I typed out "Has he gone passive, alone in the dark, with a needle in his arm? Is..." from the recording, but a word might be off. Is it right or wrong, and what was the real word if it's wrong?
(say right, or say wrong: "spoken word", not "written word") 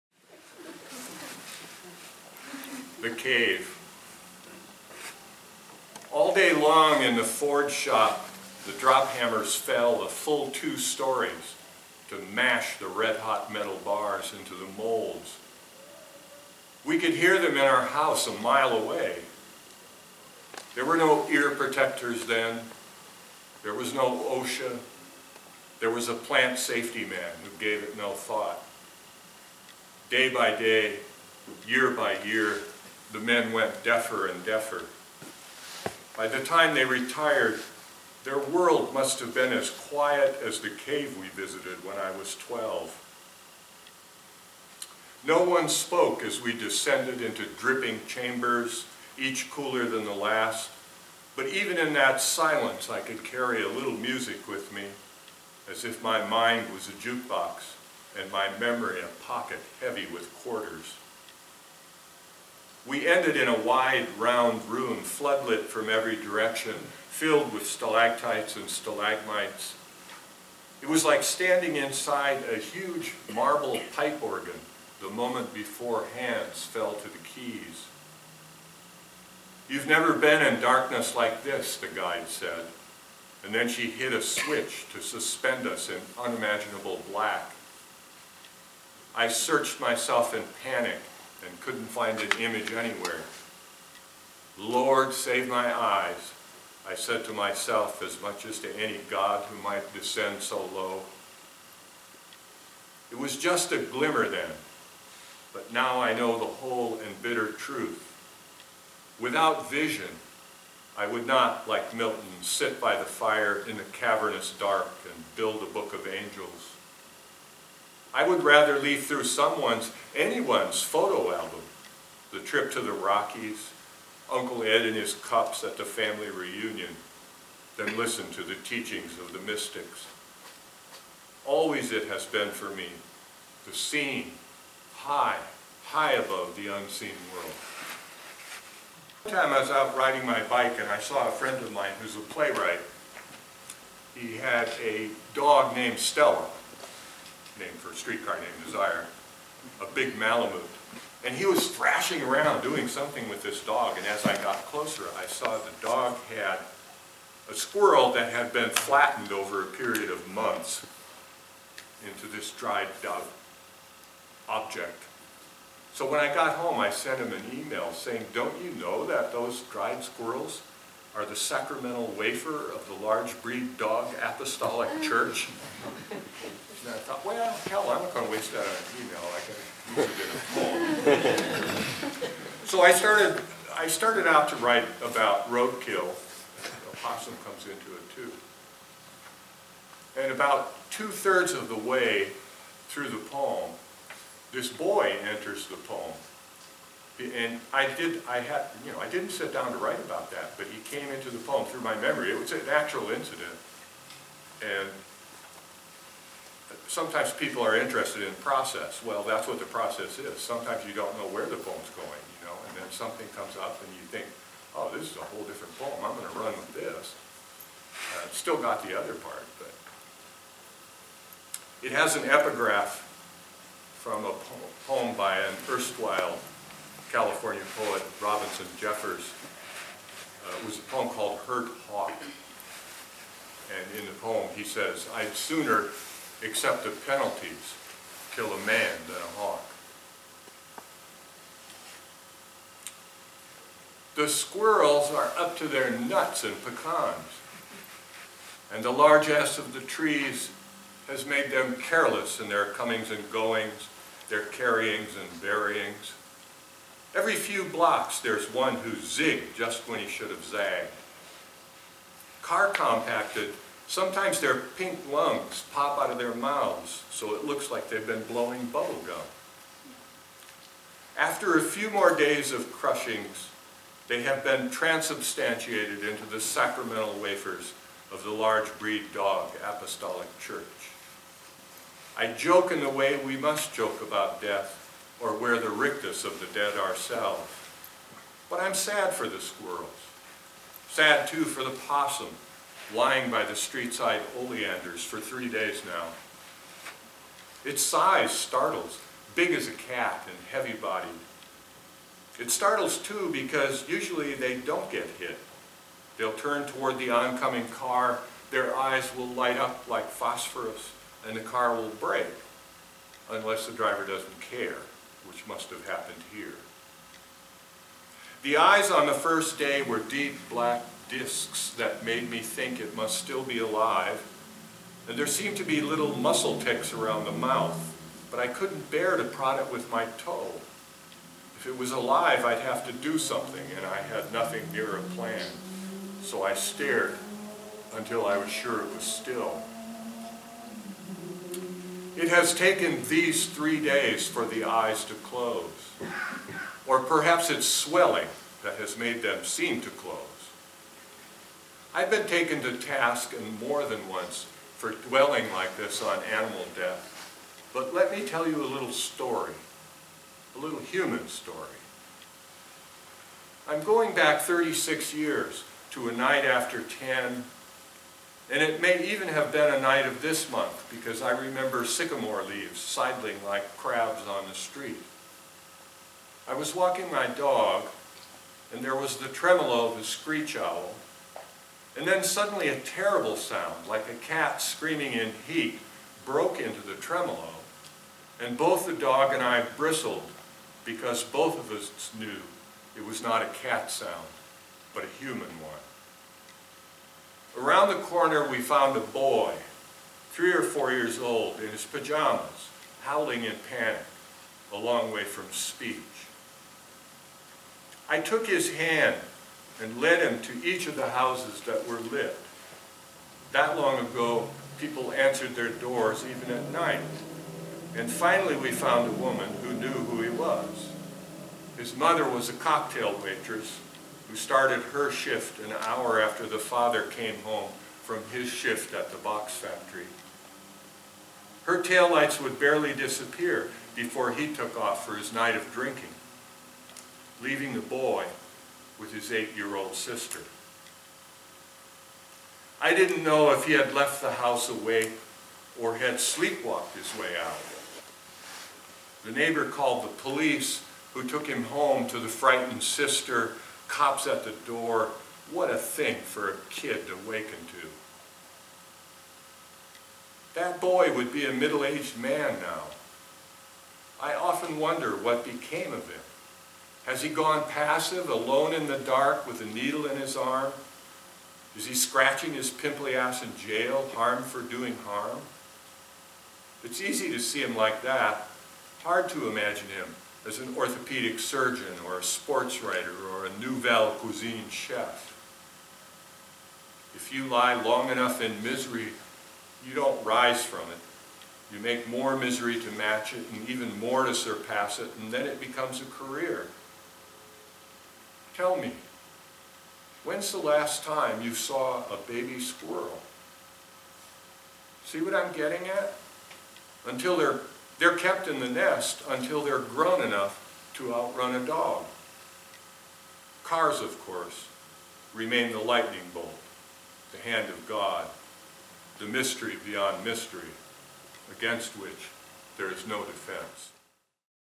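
right.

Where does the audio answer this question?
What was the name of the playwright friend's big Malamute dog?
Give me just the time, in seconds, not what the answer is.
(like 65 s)
145 s.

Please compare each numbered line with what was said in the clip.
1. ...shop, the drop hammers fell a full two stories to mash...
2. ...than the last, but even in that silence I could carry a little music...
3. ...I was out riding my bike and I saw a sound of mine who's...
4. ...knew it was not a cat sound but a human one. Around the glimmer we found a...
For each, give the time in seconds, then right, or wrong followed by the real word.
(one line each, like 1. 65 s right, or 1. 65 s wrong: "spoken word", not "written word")
1. 7 s right
2. 49 s right
3. 139 s wrong: "friend", not "sound"
4. 392 s wrong: "corner", not "glimmer".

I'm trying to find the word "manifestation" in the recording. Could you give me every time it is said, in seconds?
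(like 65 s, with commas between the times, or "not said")
not said.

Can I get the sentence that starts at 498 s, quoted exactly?
Tell me, when's the last time you saw a baby squirrel?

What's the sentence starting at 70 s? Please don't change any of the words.
It was like standing inside a huge marble pipe organ the moment before hands fell to the keys.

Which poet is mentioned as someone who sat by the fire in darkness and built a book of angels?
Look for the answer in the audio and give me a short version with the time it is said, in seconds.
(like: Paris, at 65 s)
Milton, at 111 s.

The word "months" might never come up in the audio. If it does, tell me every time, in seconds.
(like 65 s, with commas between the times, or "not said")
160 s, 370 s.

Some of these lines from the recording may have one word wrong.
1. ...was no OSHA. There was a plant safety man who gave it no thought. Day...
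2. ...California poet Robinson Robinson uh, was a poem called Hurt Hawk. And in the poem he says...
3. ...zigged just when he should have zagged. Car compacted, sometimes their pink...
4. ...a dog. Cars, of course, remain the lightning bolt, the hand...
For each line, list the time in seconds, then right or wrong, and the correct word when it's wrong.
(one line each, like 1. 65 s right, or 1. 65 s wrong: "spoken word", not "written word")
1. 23 s right
2. 227 s wrong: "Jeffers", not "Robinson"
3. 258 s right
4. 511 s right.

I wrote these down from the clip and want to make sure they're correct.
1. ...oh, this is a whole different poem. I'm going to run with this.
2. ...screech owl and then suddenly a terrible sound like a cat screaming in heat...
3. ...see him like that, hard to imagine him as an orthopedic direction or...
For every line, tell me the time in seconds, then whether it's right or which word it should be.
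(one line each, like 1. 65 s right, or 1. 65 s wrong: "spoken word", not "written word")
1. 214 s right
2. 380 s right
3. 477 s wrong: "surgeon", not "direction".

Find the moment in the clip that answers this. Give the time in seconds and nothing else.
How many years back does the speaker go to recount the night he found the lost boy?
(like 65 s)
364 s.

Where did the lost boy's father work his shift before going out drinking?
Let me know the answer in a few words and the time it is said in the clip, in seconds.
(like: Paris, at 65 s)
Box factory, at 429 s.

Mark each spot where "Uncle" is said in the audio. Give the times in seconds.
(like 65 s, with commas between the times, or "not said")
124 s.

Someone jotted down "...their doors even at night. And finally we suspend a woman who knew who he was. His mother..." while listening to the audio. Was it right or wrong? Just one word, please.
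wrong.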